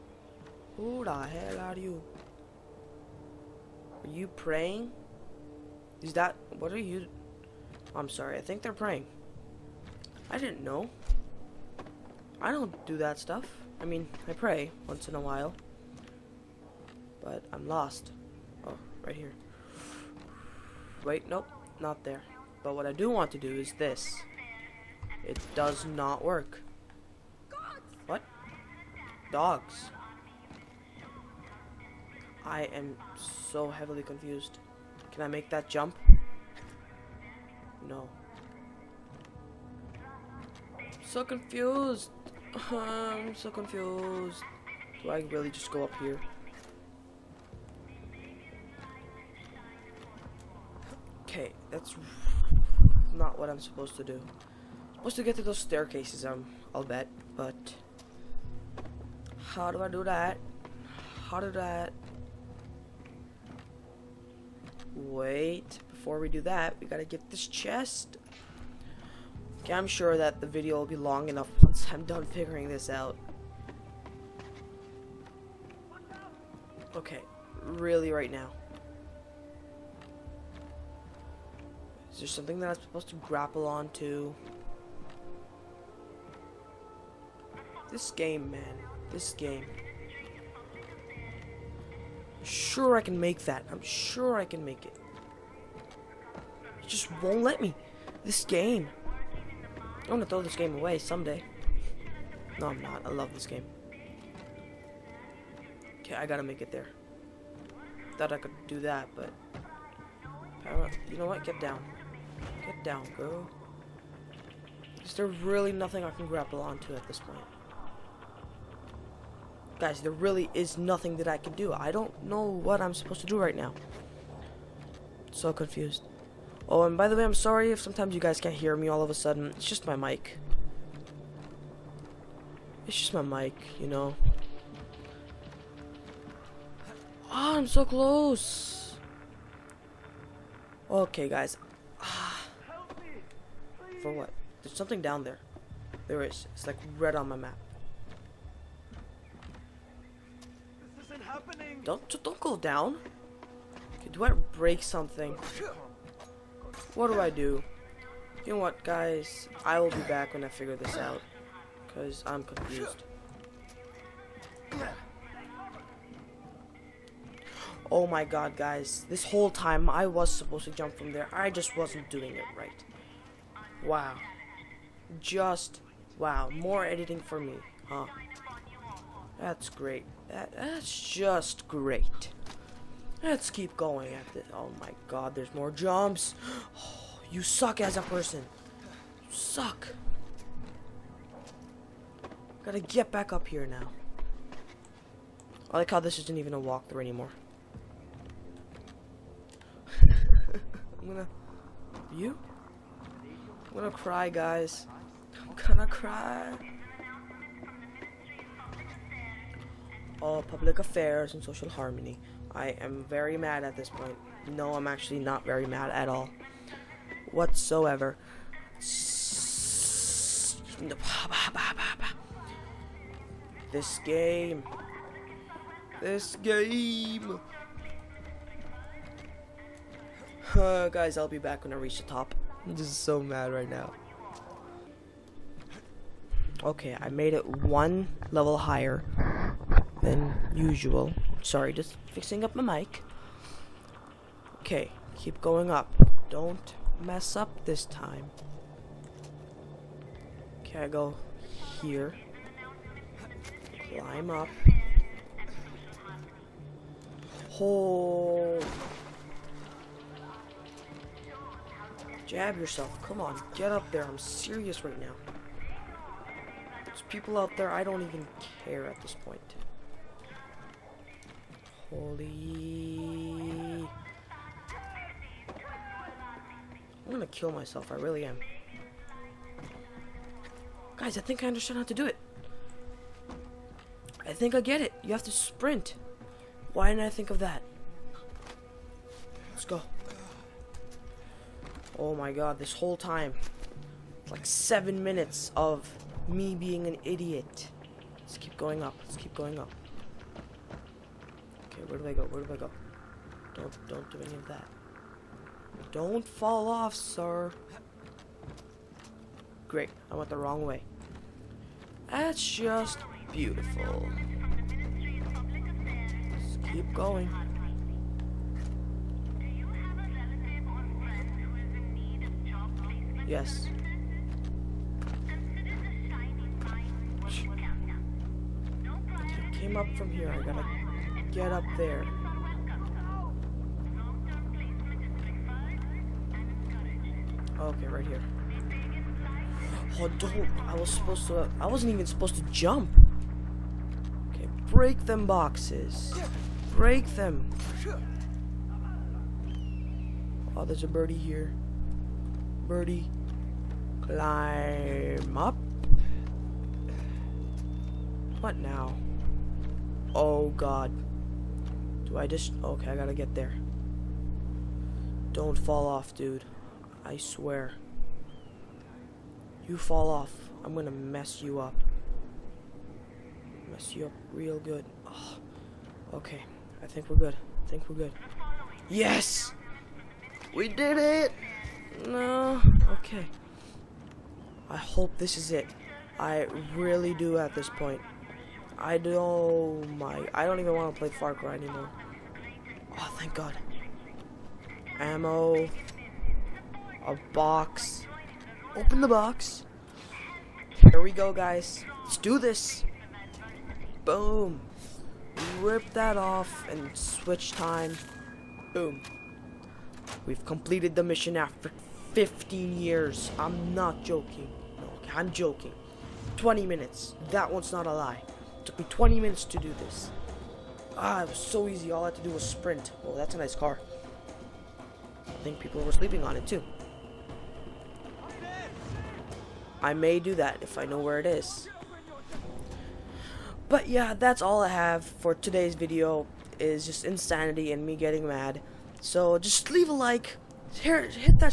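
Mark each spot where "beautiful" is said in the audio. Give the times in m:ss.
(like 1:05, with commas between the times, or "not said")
5:13.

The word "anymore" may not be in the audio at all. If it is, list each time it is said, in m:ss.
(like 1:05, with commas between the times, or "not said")
3:17, 6:31.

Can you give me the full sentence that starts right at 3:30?
Oh, public affairs and social harmony.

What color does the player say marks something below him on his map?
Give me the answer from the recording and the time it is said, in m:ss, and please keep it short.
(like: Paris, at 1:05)
Red, at 2:26.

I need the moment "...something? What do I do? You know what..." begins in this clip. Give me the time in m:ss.
2:34.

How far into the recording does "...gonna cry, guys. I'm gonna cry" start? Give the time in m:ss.
3:23.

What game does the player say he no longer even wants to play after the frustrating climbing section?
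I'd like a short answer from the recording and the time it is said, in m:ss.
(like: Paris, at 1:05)
Far Cry, at 6:31.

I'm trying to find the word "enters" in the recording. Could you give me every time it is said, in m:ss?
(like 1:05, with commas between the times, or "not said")
not said.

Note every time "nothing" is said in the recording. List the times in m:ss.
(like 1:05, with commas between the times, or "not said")
1:55, 2:00.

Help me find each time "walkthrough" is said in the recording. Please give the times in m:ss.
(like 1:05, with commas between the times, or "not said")
3:16.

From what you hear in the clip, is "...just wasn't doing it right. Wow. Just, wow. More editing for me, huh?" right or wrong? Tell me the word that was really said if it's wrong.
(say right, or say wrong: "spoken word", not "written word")
right.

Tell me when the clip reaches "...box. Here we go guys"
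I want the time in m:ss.
6:39.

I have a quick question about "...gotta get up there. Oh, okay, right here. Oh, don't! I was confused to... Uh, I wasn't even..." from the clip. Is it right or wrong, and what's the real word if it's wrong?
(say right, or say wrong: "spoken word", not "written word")
wrong: "supposed", not "confused".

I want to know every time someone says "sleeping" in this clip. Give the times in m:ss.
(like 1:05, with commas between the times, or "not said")
7:05.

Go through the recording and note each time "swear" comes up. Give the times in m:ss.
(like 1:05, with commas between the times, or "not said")
6:07.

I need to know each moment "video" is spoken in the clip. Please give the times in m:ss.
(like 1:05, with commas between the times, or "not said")
1:10, 7:15.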